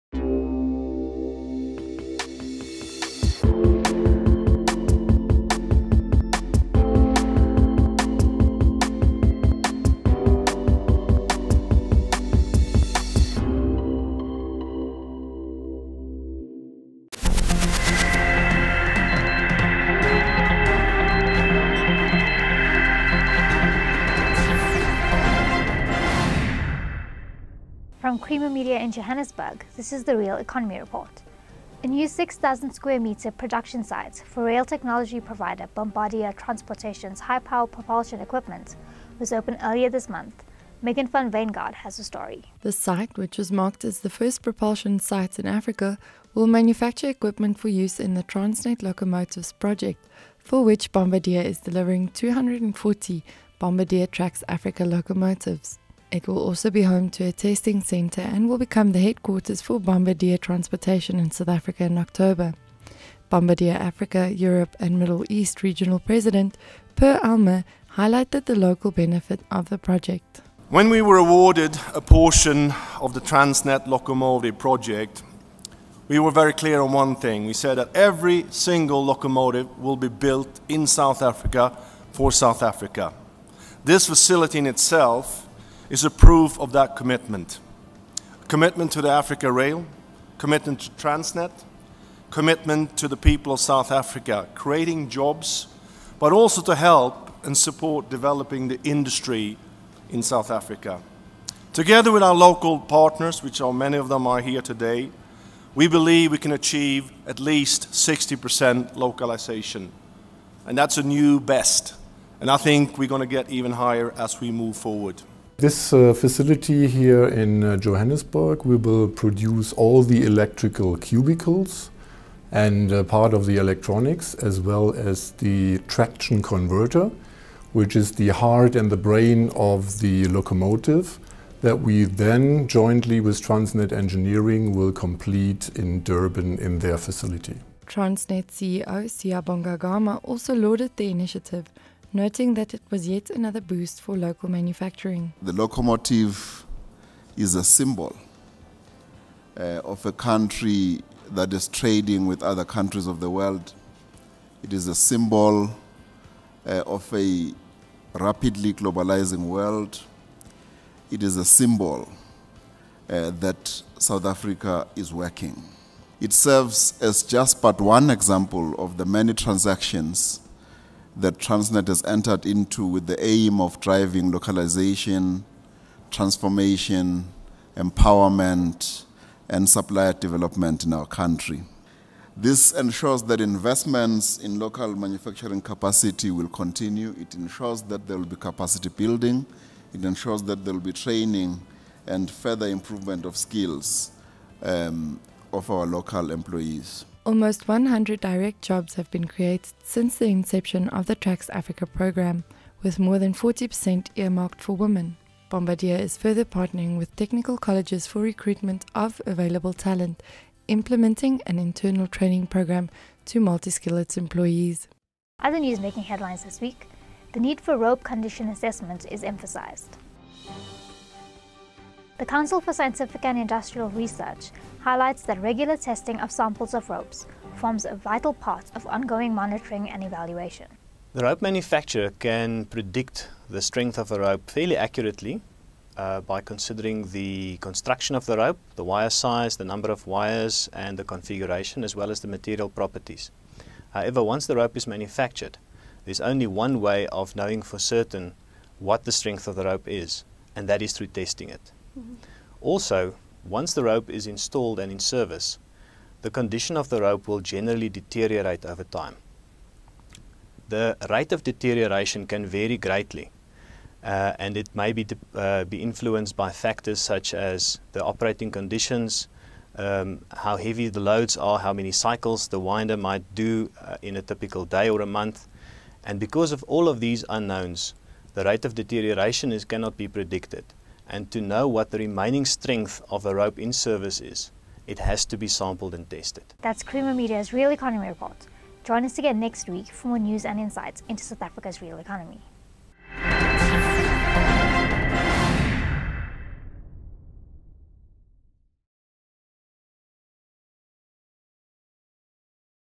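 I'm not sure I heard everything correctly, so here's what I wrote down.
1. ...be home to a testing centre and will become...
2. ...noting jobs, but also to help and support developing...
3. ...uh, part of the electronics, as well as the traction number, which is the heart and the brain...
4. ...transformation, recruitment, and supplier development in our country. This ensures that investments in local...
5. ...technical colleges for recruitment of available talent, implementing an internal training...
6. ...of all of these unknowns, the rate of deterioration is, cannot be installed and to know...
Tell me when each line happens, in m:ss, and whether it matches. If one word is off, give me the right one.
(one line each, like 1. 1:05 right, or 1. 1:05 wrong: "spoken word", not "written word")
1. 0:56 right
2. 1:34 wrong: "creating", not "noting"
3. 2:02 wrong: "converter", not "number"
4. 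2:56 wrong: "empowerment", not "recruitment"
5. 3:27 right
6. 4:36 wrong: "predicted", not "installed".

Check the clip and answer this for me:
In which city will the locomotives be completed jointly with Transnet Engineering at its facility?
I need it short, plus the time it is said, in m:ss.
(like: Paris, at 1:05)
Durban, at 2:16.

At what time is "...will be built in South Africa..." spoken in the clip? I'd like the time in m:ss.
1:19.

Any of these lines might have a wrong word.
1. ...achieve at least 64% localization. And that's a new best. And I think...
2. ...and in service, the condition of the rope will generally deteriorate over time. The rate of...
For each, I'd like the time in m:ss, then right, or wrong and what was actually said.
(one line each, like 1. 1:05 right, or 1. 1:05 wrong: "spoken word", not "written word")
1. 1:46 wrong: "60", not "64"
2. 4:14 right.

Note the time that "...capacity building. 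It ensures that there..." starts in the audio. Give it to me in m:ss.
3:08.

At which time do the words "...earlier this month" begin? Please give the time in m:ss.
0:39.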